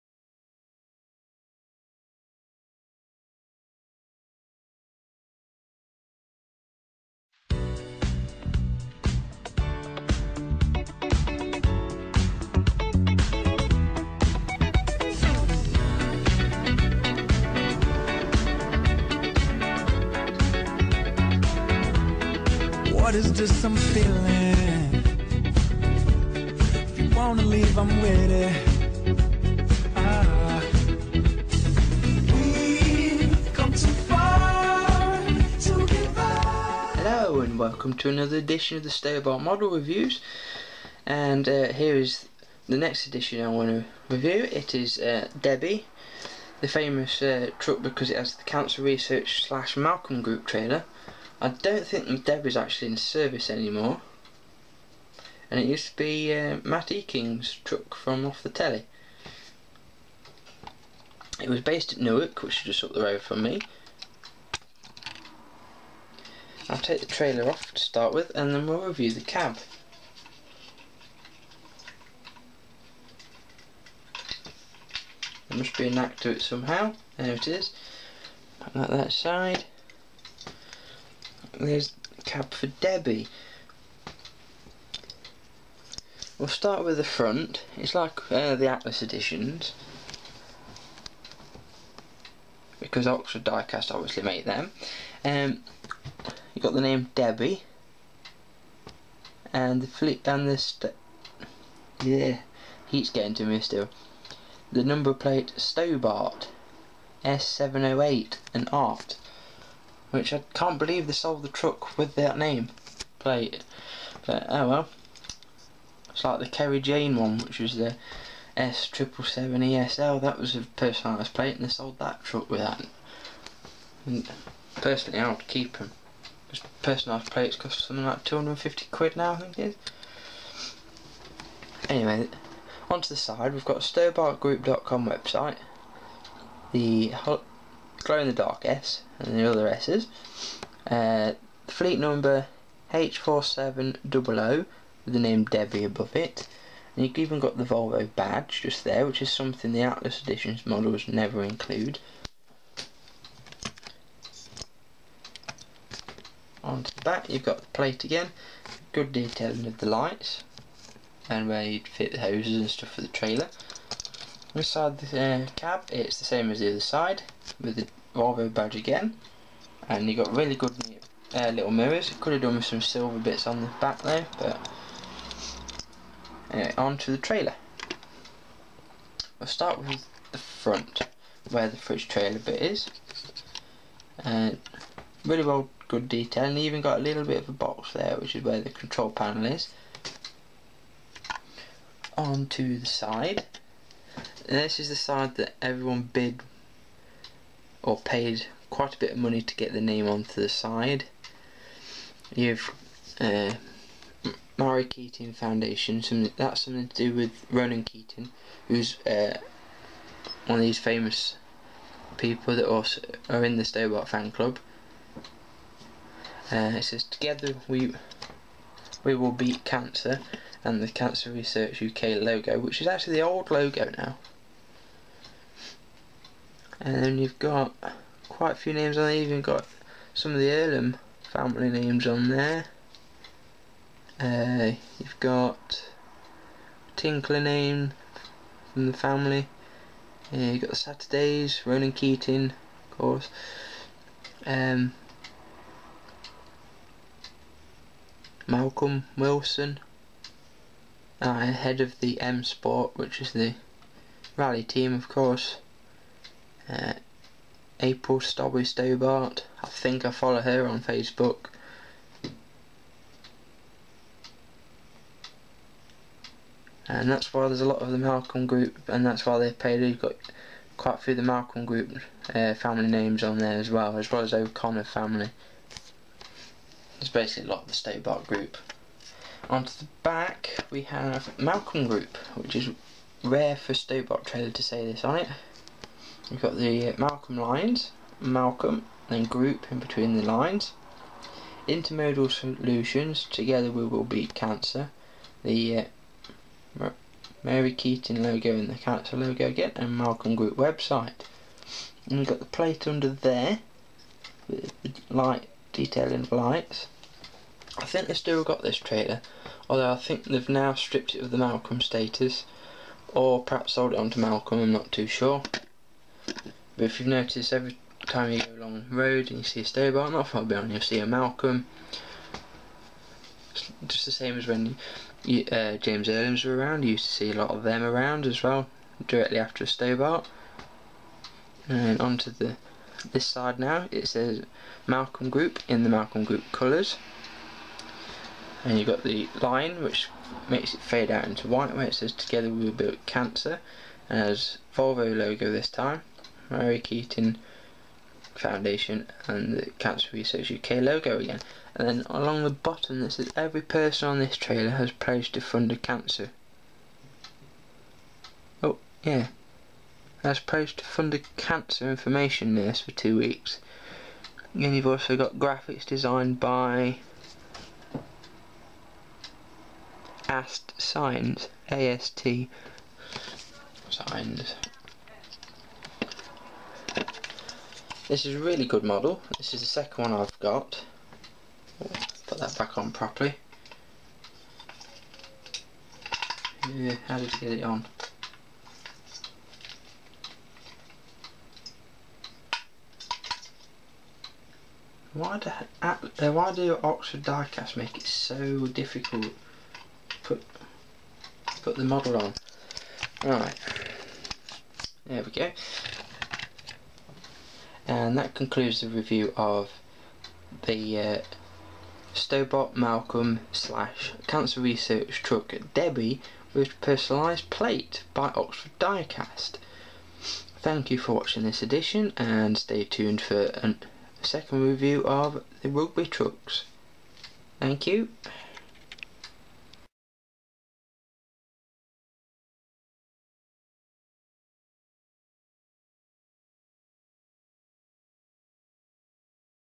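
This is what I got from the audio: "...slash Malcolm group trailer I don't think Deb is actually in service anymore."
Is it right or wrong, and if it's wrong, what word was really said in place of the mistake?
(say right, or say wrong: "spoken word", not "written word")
right.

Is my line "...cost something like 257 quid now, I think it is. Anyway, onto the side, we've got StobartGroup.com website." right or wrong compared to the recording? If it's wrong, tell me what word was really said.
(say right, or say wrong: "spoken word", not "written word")
wrong: "250", not "257".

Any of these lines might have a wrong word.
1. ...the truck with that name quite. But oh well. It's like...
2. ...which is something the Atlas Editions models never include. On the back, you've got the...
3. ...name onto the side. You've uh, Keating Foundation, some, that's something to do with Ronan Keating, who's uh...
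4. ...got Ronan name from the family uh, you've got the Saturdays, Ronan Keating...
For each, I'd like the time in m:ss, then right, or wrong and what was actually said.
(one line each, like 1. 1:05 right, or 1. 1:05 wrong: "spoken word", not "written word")
1. 1:51 wrong: "plate", not "quite"
2. 2:29 right
3. 3:19 right
4. 3:55 wrong: "Tinkler", not "Ronan".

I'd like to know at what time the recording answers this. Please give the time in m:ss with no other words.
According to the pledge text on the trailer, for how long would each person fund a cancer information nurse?
6:02.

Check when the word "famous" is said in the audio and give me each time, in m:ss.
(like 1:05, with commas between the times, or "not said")
0:46, 3:30.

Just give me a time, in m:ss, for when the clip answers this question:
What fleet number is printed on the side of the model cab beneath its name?
2:22.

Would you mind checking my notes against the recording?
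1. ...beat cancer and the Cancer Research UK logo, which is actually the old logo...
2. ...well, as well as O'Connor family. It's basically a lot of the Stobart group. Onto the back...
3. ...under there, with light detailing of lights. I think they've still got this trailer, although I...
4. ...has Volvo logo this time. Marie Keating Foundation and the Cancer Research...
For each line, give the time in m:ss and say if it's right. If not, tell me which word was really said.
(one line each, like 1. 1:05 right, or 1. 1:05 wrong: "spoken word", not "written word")
1. 3:39 right
2. 4:33 right
3. 5:02 right
4. 5:44 right.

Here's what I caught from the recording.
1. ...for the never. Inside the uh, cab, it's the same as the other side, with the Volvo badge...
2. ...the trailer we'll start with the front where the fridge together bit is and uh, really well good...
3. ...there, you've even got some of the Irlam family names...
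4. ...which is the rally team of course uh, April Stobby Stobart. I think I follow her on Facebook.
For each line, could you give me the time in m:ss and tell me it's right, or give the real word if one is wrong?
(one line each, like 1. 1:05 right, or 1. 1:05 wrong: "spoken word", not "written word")
1. 2:42 wrong: "trailer", not "never"
2. 2:57 wrong: "trailer", not "together"
3. 3:49 right
4. 4:12 right.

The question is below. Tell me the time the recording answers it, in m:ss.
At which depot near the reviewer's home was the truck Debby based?
1:01.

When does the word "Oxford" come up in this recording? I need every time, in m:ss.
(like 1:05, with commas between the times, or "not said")
1:33, 6:36, 6:58.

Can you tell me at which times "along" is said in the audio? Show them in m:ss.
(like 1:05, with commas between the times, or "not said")
5:18, 5:52.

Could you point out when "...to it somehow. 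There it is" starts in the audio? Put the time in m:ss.
1:16.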